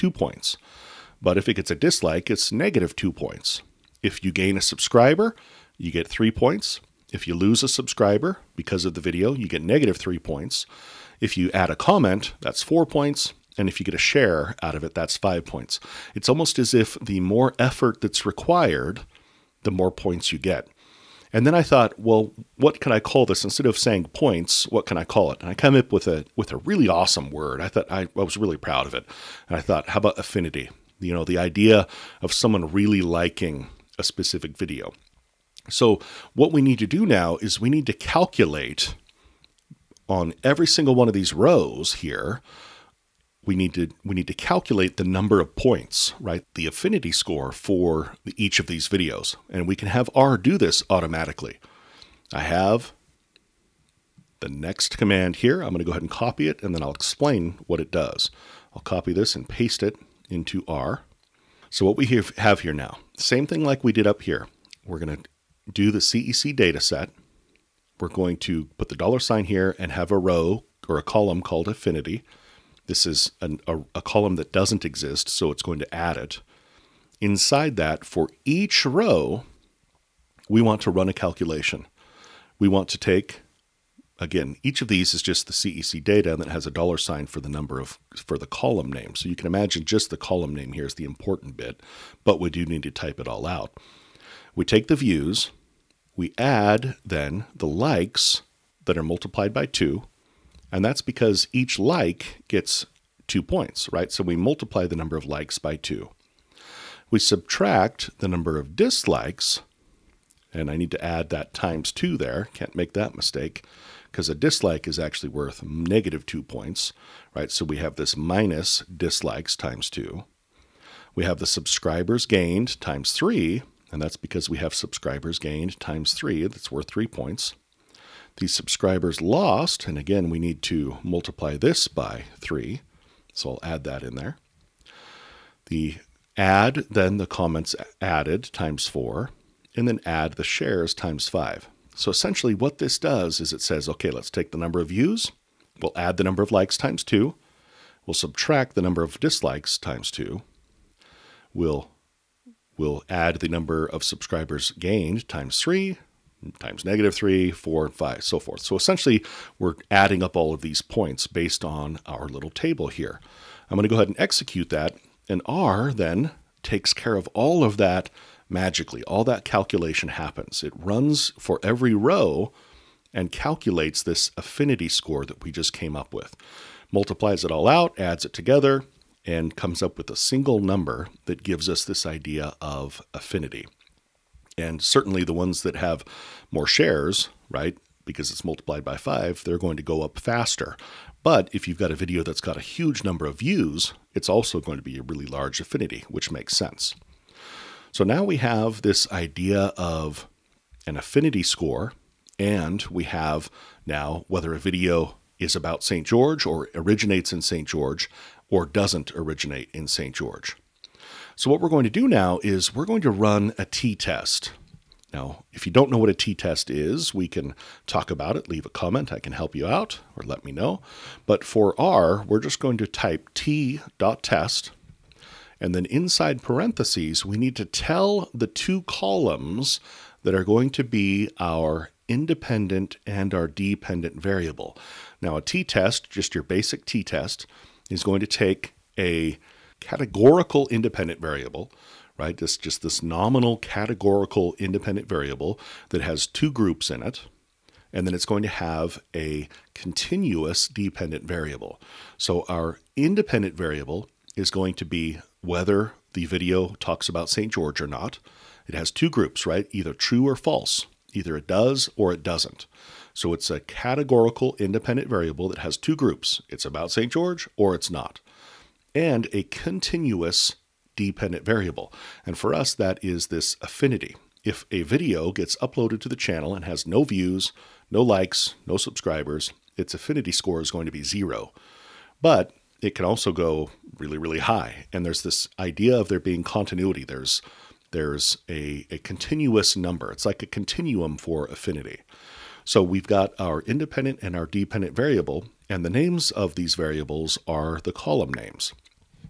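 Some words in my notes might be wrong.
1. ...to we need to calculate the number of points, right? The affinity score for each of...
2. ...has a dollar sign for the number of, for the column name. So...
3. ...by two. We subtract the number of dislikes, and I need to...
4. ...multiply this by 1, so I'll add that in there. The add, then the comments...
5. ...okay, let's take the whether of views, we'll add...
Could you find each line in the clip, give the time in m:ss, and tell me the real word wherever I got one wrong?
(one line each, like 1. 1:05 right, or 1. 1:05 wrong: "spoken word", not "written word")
1. 0:43 right
2. 1:26 right
3. 1:45 right
4. 2:11 wrong: "3", not "1"
5. 2:23 wrong: "number", not "whether".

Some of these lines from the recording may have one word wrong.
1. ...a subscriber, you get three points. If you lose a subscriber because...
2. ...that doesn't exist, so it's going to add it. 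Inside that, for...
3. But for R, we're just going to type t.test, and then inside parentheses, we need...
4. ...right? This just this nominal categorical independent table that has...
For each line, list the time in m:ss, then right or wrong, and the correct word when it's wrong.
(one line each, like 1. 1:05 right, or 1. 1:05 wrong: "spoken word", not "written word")
1. 0:04 right
2. 1:14 right
3. 3:41 right
4. 4:02 wrong: "variable", not "table".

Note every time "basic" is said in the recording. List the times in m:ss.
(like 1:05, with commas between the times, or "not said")
3:56.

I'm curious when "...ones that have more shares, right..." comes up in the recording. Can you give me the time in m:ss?
3:05.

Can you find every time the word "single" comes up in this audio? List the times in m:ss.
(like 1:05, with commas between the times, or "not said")
0:40, 3:00.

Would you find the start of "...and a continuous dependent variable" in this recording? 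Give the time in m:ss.
4:28.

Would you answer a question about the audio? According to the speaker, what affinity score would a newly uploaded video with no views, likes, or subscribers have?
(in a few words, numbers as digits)
0.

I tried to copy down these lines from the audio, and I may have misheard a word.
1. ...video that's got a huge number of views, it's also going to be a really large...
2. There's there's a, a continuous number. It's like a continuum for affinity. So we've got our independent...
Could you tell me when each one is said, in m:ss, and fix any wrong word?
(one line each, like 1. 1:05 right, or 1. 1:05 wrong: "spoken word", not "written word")
1. 3:11 right
2. 4:47 right.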